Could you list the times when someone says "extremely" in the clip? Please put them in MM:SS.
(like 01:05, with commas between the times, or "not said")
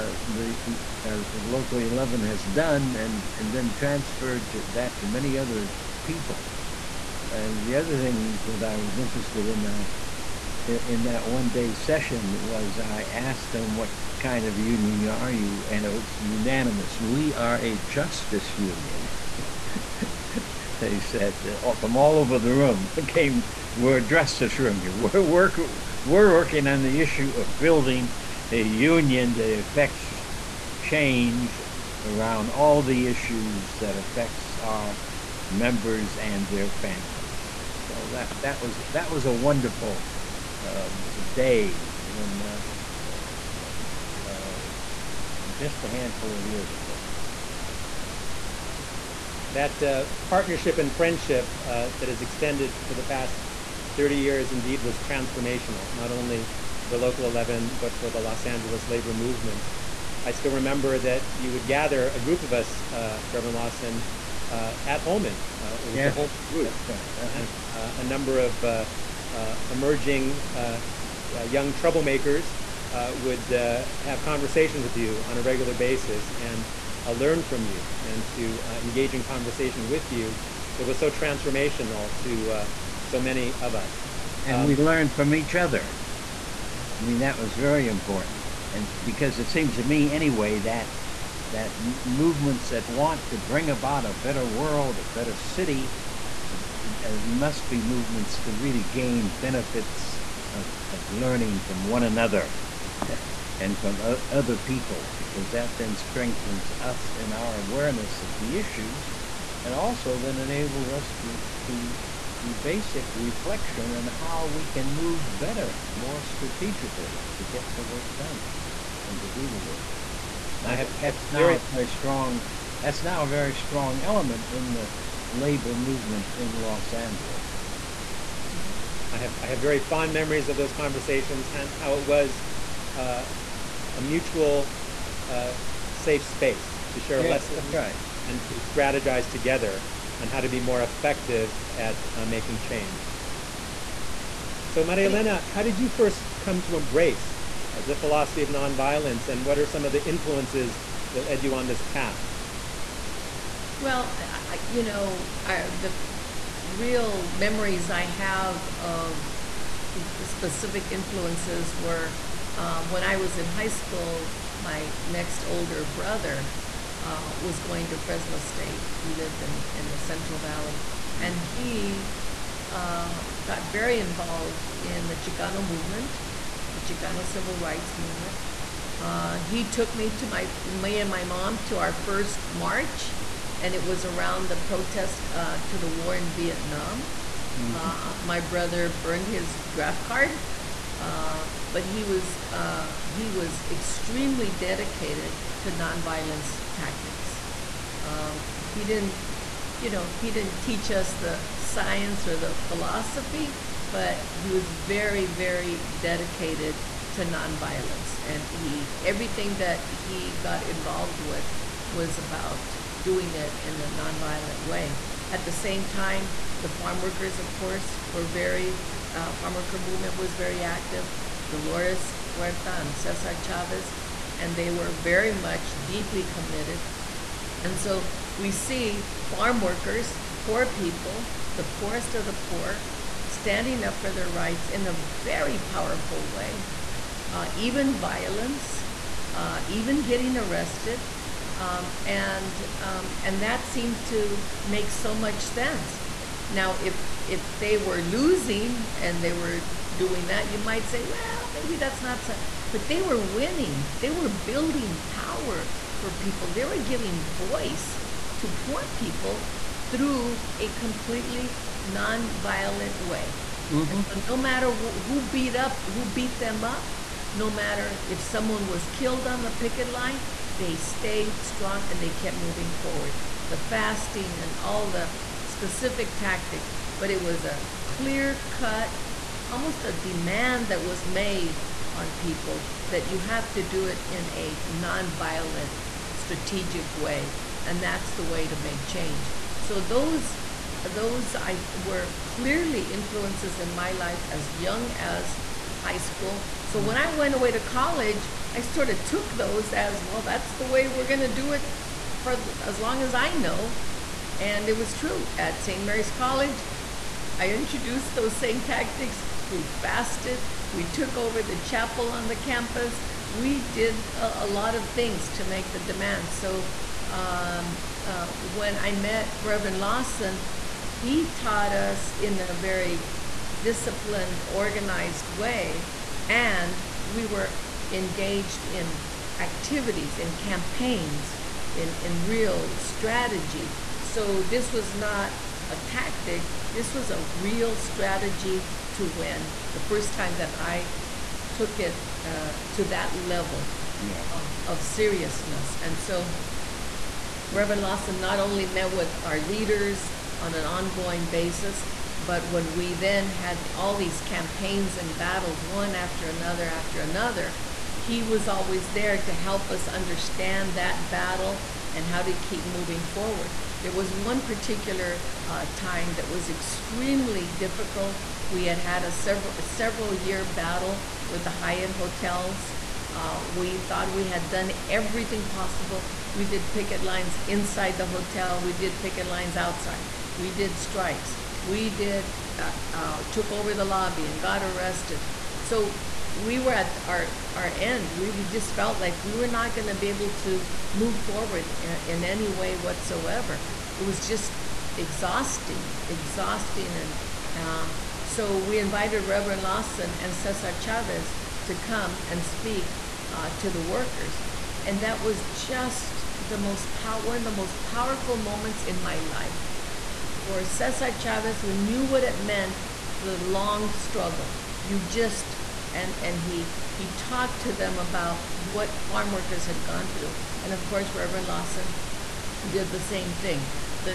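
03:13, 06:06.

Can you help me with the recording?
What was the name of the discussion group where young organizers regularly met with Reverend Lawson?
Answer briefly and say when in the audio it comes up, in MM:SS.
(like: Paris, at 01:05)
The Holman group, at 01:06.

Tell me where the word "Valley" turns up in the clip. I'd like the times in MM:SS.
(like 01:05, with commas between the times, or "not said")
02:50.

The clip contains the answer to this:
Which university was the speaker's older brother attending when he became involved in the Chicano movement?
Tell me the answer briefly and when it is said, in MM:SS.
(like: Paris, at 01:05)
Fresno State, at 02:47.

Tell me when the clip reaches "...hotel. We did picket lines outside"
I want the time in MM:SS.
06:18.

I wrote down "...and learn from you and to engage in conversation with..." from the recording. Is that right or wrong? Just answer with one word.
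right.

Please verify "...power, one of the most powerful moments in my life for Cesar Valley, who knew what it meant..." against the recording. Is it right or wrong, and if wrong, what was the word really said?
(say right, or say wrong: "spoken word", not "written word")
wrong: "Chavez", not "Valley".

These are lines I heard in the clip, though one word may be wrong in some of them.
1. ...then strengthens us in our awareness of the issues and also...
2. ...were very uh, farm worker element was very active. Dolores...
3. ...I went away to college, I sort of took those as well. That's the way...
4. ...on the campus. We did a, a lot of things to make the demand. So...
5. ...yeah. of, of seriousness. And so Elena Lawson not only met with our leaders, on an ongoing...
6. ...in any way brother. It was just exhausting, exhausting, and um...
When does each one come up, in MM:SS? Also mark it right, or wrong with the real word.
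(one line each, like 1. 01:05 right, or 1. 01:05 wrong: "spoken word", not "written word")
1. 01:45 right
2. 03:38 wrong: "movement", not "element"
3. 04:56 right
4. 05:12 right
5. 05:43 wrong: "Reverend", not "Elena"
6. 06:32 wrong: "whatsoever", not "brother".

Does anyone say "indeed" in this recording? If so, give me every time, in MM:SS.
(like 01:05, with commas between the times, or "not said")
00:54.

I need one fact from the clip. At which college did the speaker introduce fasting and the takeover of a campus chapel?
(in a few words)
St. Mary's College.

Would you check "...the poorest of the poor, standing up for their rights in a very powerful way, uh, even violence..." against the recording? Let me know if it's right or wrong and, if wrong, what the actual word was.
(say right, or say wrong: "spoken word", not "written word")
right.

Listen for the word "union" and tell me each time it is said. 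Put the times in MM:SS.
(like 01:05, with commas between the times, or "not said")
00:14, 00:18, 00:24, 00:28.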